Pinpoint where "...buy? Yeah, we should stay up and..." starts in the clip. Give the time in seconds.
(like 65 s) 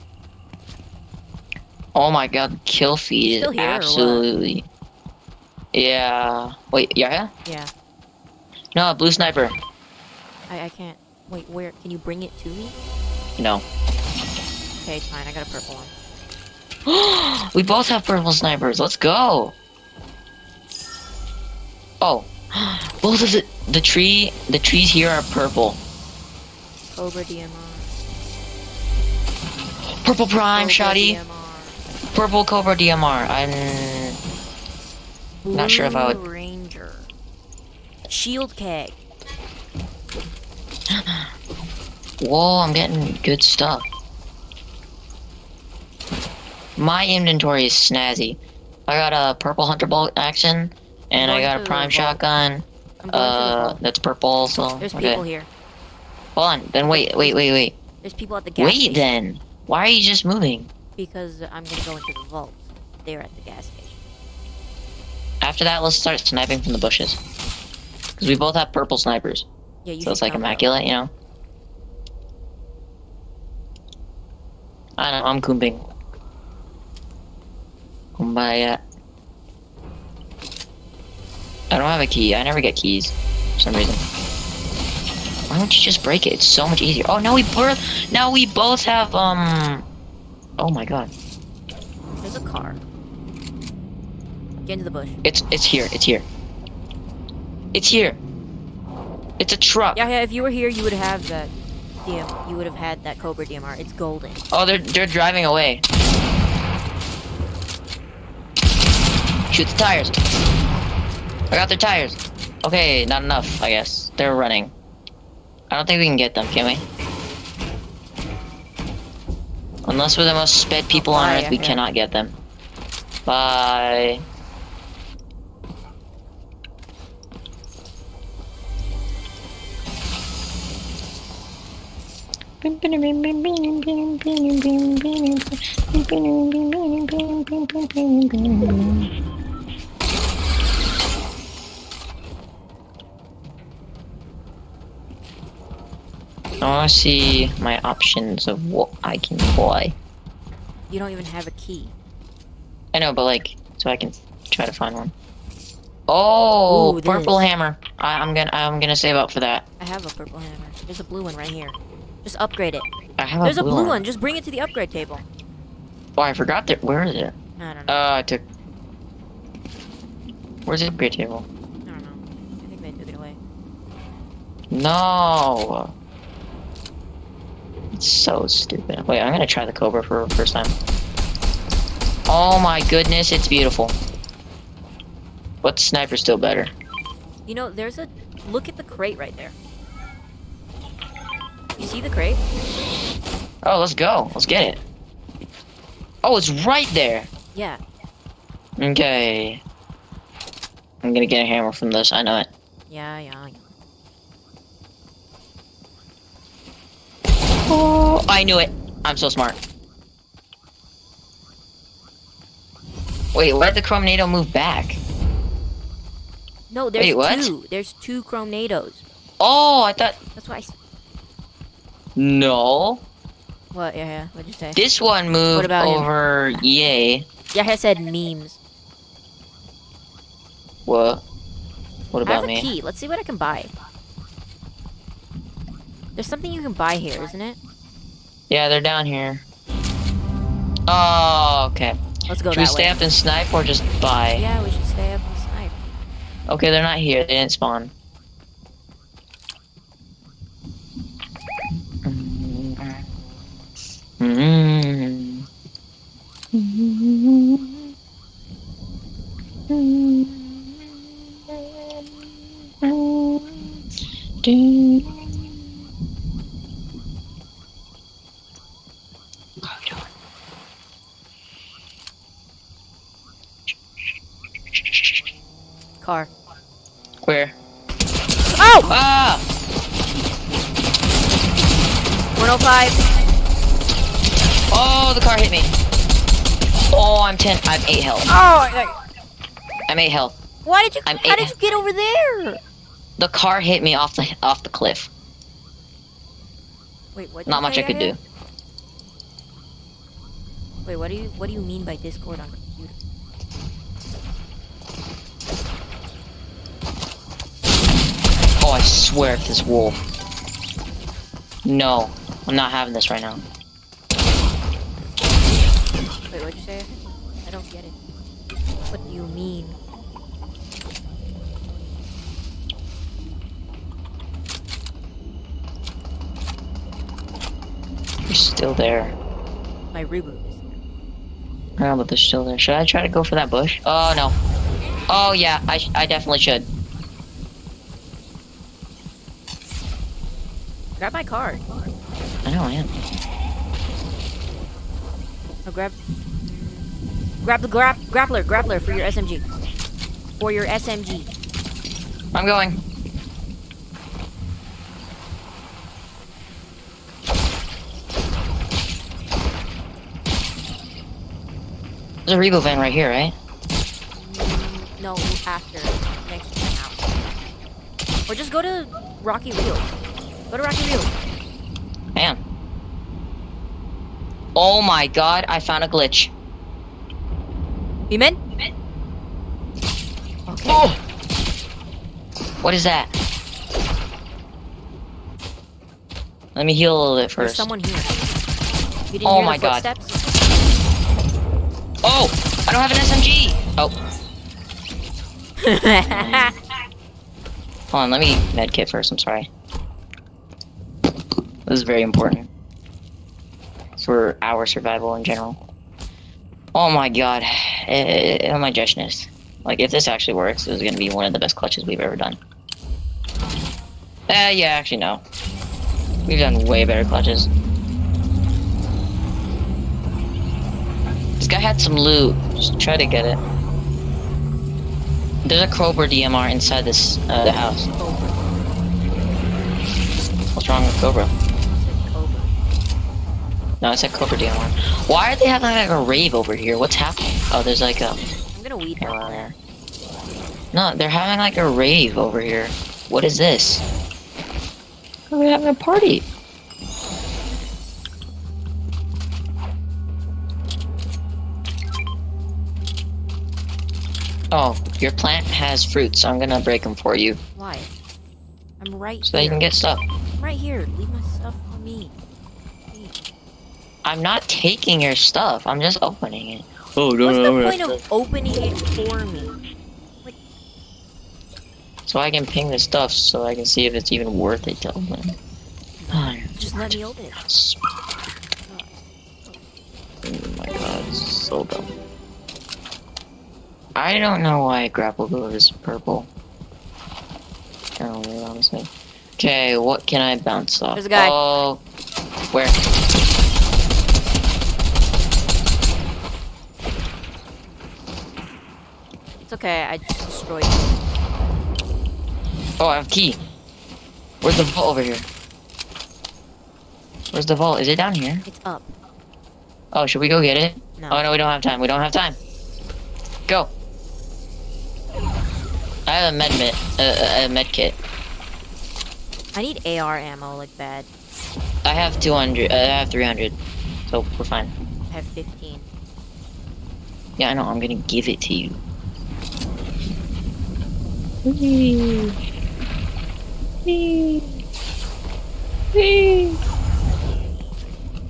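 244 s.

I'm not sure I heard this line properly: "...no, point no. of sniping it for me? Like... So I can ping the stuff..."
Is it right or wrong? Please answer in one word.
wrong.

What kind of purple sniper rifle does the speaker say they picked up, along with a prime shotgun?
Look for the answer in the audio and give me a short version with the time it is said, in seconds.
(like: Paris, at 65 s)
Hunter bolt action, at 49 s.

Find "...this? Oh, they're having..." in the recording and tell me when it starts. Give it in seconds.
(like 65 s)
443 s.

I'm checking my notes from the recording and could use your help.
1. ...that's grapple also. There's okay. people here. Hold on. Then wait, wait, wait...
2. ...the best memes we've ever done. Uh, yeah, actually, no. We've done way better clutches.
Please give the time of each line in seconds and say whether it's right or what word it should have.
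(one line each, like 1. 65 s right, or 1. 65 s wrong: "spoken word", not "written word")
1. 53 s wrong: "purple", not "grapple"
2. 411 s wrong: "clutches", not "memes".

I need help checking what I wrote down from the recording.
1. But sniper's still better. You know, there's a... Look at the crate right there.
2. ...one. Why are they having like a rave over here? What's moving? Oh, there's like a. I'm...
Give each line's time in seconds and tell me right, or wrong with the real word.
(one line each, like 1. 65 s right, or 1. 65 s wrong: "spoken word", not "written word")
1. 185 s right
2. 434 s wrong: "happening", not "moving".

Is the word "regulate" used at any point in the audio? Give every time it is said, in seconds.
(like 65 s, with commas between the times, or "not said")
not said.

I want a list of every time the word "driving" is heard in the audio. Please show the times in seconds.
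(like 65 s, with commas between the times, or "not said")
105 s.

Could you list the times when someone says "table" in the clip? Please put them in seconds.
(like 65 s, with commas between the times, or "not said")
164 s, 171 s.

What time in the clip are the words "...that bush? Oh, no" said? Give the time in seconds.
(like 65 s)
333 s.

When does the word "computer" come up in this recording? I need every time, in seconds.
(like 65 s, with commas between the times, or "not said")
302 s.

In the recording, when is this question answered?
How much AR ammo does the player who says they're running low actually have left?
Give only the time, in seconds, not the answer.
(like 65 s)
525 s.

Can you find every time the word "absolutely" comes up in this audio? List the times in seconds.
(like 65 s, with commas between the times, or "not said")
3 s.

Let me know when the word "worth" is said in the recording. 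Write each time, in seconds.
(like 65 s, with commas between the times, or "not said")
474 s.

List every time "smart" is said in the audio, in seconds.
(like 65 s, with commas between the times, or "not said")
209 s.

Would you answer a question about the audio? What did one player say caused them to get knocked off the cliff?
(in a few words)
The car.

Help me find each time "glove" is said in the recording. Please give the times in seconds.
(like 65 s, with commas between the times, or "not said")
485 s.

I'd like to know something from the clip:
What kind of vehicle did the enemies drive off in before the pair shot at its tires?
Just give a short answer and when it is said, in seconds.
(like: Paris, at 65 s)
Truck, at 99 s.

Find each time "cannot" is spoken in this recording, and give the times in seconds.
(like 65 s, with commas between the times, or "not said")
121 s.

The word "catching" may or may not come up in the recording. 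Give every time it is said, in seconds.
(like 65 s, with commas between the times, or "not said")
not said.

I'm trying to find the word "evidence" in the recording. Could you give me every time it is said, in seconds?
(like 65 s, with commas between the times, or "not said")
not said.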